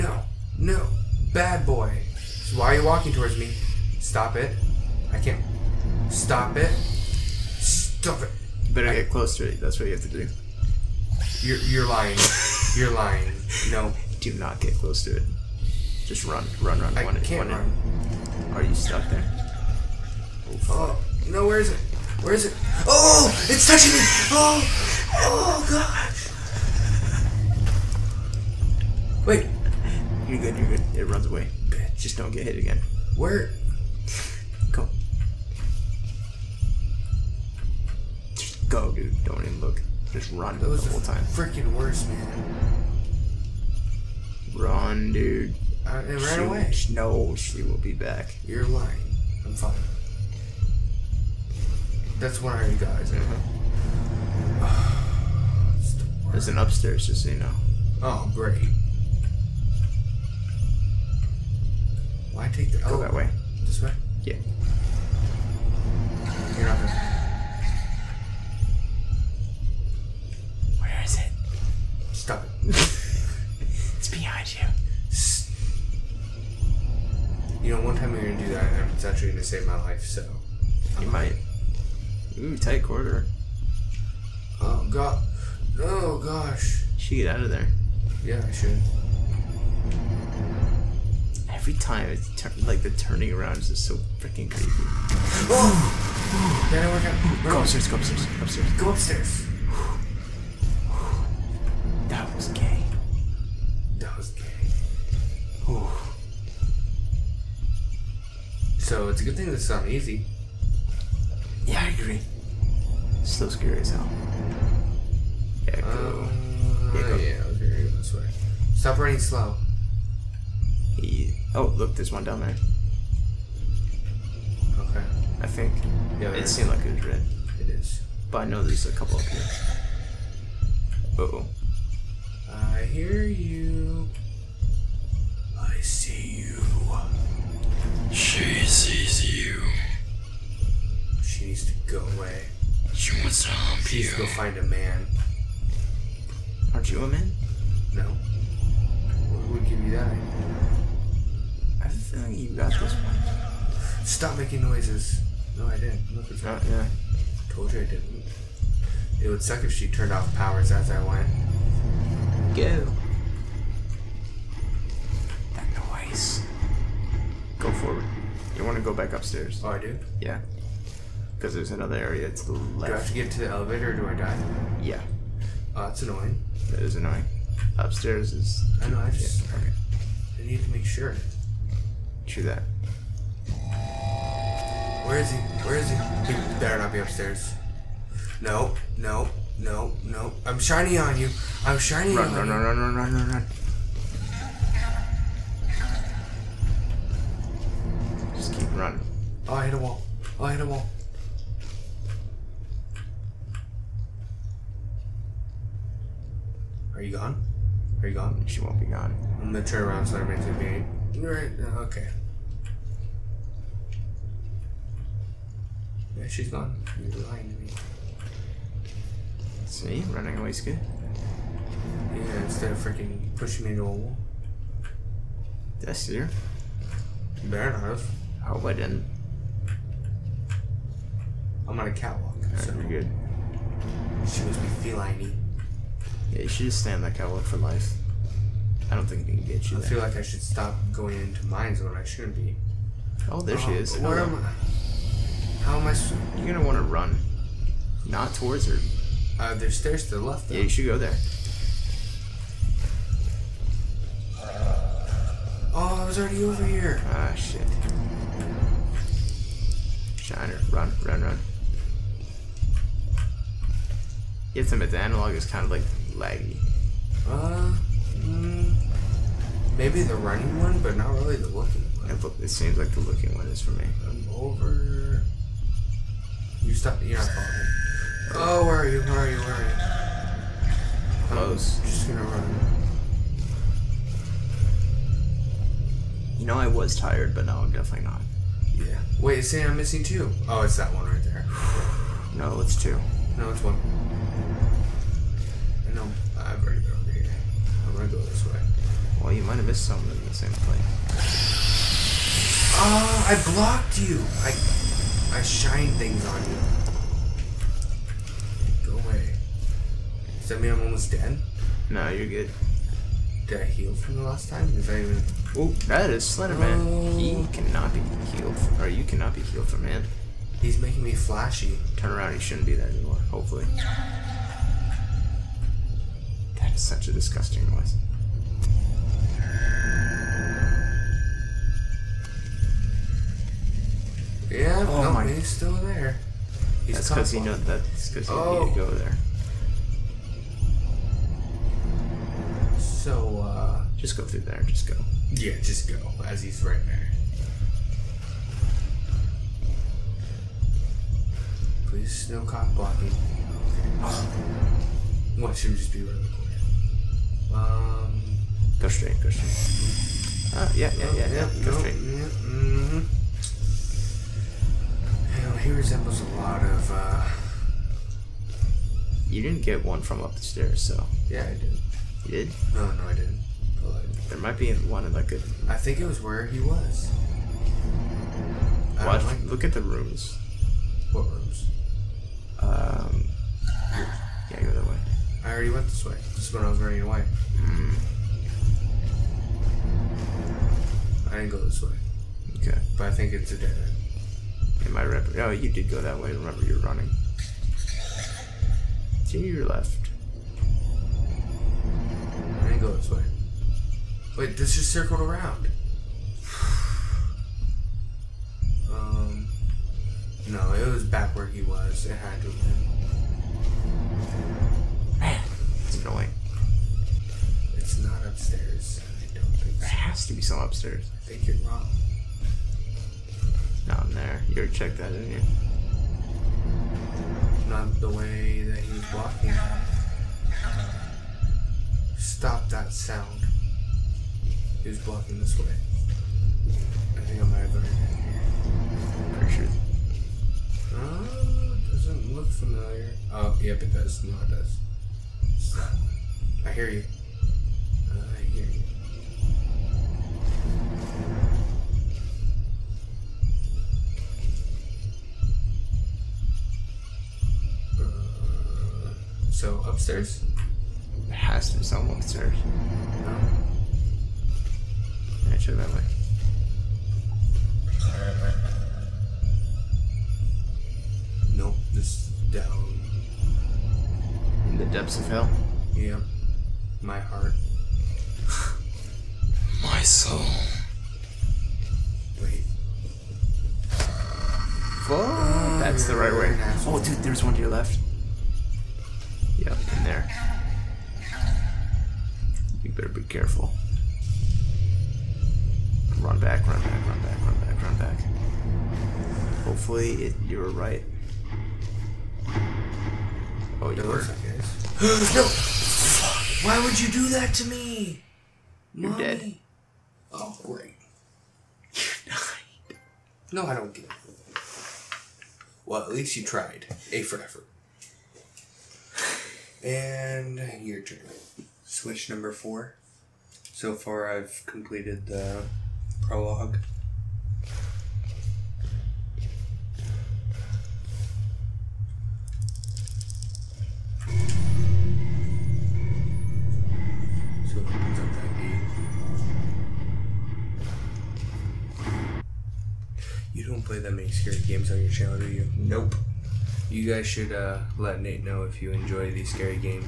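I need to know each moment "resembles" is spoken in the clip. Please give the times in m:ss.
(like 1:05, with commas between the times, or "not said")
6:05.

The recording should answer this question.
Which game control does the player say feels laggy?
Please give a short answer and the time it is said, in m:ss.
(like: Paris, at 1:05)
The analog, at 4:24.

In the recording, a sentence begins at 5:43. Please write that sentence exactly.
Just go through there, just go.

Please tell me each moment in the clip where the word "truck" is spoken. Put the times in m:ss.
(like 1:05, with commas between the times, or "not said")
not said.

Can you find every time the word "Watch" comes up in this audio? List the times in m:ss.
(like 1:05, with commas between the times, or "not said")
5:55, 6:19.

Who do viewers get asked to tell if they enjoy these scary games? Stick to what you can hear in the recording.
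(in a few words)
Nate.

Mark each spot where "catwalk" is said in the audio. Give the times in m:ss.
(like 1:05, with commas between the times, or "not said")
3:51, 3:57.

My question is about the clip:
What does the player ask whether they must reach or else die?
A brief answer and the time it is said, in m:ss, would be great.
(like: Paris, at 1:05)
The elevator, at 2:53.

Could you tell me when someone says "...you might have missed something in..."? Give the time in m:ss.
4:59.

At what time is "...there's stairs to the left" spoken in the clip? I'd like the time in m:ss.
4:09.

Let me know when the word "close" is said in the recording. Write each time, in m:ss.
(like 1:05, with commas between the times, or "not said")
0:09, 0:14, 4:41.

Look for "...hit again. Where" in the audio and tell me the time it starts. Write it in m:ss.
0:32.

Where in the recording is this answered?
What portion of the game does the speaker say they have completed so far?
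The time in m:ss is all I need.
8:46.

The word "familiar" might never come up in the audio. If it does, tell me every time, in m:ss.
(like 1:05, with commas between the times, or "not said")
7:22.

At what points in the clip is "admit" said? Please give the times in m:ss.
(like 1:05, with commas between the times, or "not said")
4:24.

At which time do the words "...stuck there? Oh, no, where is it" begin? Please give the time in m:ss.
0:18.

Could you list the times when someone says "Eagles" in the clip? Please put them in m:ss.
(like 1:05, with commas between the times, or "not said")
not said.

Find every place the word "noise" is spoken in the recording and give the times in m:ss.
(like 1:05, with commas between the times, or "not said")
2:34, 2:45, 5:27.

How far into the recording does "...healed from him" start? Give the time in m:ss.
5:19.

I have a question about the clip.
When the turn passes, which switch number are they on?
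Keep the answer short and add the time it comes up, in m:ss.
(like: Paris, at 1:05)
4, at 8:42.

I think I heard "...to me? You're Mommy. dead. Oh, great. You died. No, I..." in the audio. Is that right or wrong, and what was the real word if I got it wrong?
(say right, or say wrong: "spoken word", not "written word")
right.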